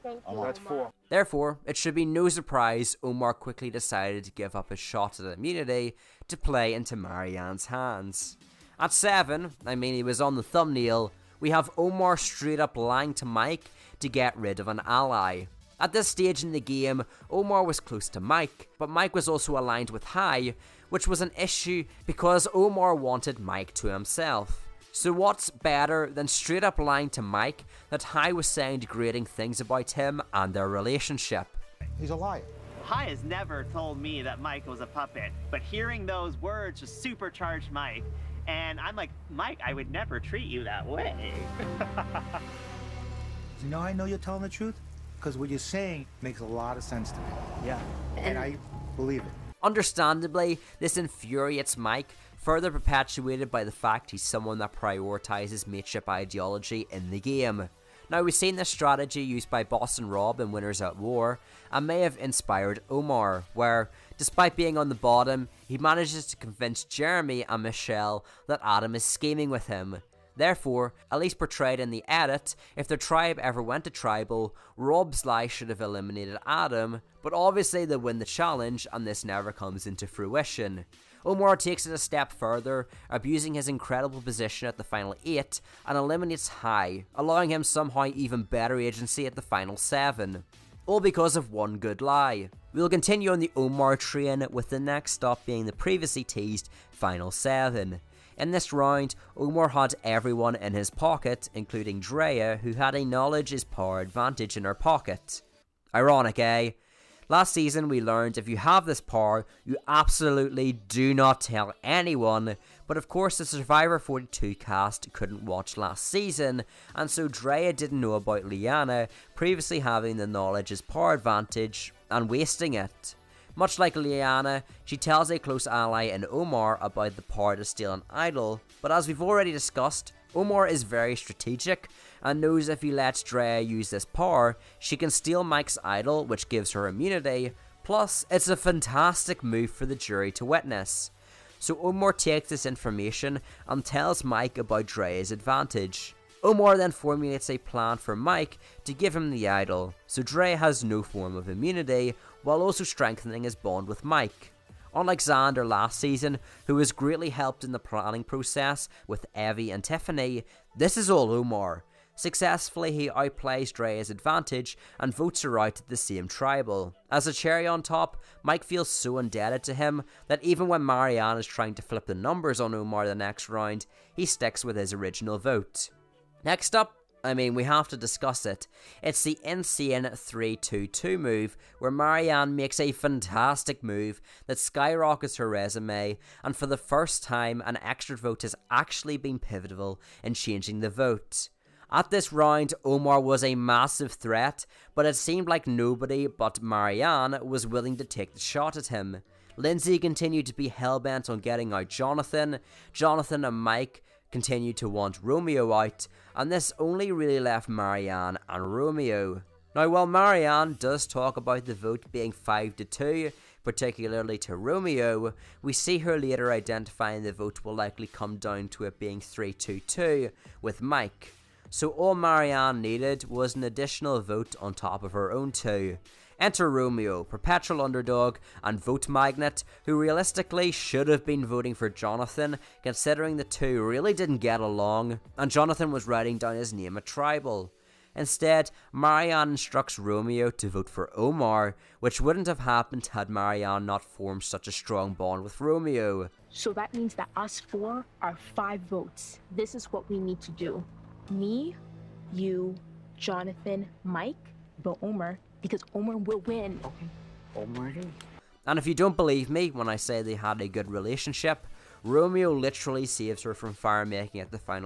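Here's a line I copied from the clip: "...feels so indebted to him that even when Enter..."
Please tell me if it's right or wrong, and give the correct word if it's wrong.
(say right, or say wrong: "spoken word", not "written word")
wrong: "Maryanne", not "Enter".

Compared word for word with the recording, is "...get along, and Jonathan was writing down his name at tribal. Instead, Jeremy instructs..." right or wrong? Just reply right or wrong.
wrong.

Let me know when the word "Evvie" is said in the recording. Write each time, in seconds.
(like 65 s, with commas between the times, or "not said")
159 s.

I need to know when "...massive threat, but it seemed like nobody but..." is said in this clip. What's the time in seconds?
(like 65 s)
193 s.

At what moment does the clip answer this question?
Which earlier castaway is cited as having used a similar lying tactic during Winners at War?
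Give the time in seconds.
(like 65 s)
59 s.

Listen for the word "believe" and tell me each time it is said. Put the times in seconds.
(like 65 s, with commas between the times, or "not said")
48 s, 259 s.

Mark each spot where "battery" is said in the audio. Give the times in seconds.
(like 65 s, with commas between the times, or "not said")
not said.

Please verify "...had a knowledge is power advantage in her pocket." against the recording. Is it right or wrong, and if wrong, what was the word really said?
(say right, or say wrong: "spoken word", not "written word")
right.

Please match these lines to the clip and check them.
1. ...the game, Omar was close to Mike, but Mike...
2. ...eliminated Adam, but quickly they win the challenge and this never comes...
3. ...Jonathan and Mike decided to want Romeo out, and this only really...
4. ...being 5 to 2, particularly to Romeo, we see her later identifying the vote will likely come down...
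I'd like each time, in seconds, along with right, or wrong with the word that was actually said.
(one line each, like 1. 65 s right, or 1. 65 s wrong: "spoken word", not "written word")
1. 16 s right
2. 75 s wrong: "obviously", not "quickly"
3. 202 s wrong: "continued", not "decided"
4. 212 s right.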